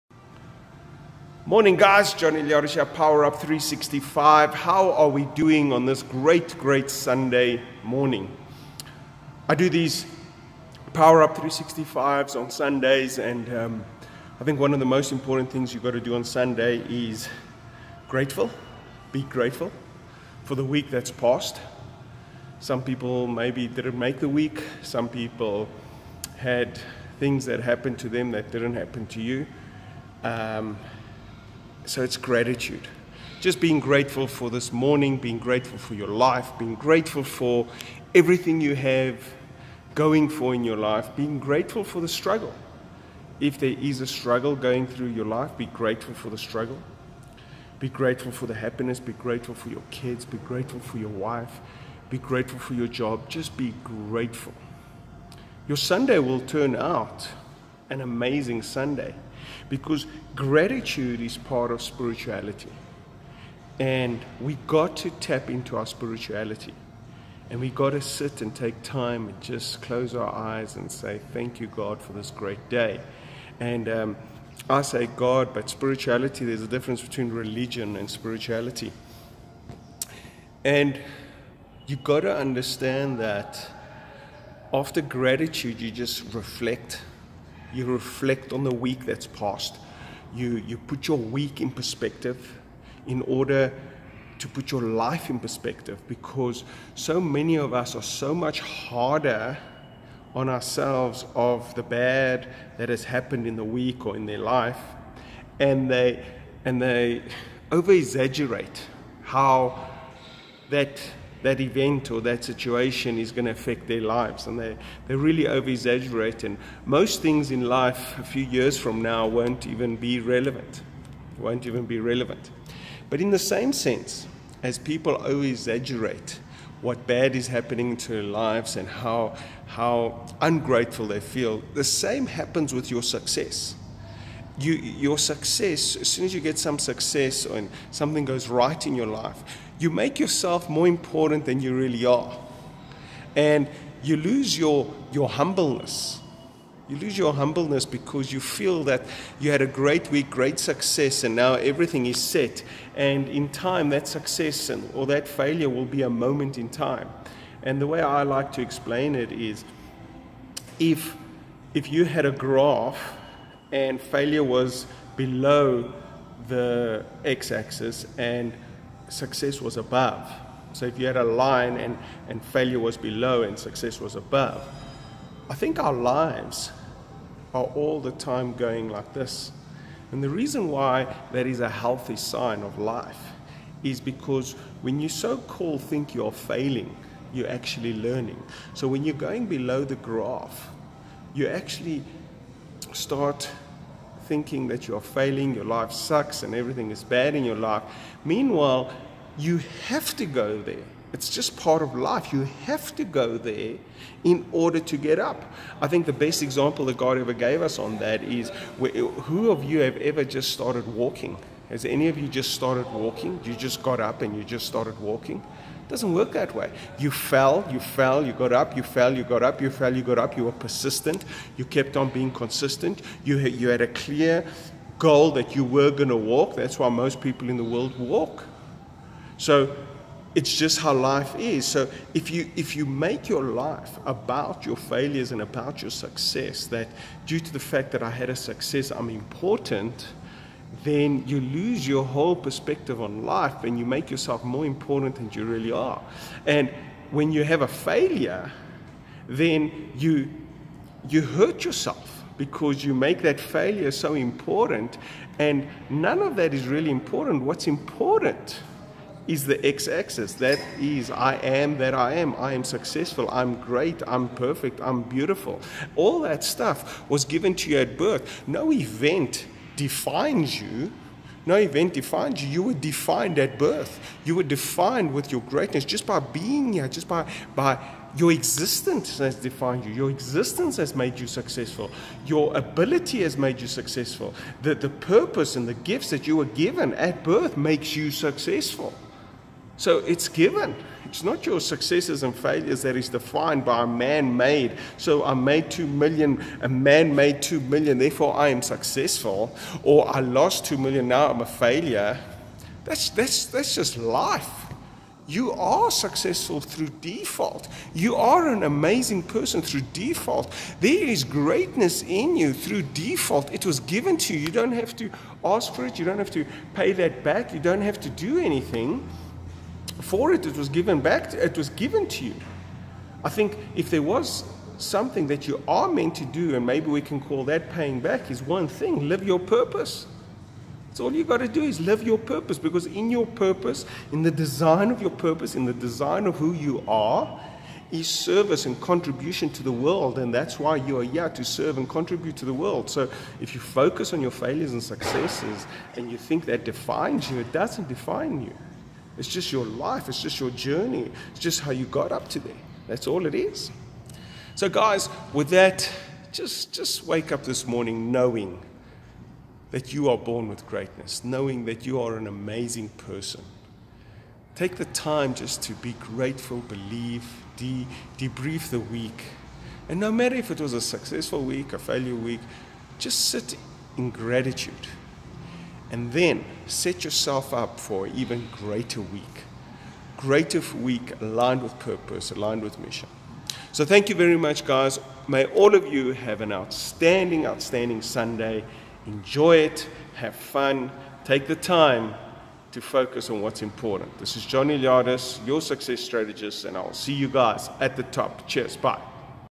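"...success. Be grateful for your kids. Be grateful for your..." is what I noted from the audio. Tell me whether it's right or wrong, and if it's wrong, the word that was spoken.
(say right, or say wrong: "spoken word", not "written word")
wrong: "happiness", not "success".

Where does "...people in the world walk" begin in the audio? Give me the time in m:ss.
3:47.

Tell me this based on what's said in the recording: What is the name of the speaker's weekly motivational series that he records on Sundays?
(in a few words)
Power Up 365.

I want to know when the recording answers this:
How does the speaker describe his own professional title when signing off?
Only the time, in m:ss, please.
6:35.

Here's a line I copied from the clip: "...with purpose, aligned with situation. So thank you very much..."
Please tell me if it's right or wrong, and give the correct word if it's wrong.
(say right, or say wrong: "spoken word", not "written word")
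wrong: "mission", not "situation".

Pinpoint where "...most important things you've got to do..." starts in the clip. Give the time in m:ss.
0:14.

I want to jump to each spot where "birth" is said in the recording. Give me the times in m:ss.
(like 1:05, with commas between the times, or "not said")
4:27, 4:33, 4:47.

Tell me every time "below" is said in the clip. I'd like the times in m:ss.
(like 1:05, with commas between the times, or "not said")
2:45, 2:52, 3:09.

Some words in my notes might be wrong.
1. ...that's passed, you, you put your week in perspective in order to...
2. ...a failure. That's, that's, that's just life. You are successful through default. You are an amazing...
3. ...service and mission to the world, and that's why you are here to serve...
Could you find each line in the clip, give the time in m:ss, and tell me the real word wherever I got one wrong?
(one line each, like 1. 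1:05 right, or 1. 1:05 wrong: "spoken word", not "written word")
1. 1:29 right
2. 5:01 right
3. 5:38 wrong: "contribution", not "mission".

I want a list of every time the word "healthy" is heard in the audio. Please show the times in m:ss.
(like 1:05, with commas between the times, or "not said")
3:01.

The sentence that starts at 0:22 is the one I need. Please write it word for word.
Some people maybe didn't make the week, some people had things that happened to them that didn't happen to you.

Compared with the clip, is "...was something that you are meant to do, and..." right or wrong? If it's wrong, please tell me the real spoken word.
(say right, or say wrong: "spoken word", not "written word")
right.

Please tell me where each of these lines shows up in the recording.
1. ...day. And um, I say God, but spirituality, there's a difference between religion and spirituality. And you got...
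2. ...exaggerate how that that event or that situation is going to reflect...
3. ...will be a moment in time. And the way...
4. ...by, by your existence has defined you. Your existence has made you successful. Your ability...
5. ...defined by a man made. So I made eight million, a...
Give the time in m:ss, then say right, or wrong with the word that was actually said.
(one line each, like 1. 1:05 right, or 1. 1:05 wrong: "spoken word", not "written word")
1. 1:12 right
2. 1:47 wrong: "affect", not "reflect"
3. 2:35 right
4. 4:37 right
5. 4:53 wrong: "two", not "eight".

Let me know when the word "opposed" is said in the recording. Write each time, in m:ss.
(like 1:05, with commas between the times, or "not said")
not said.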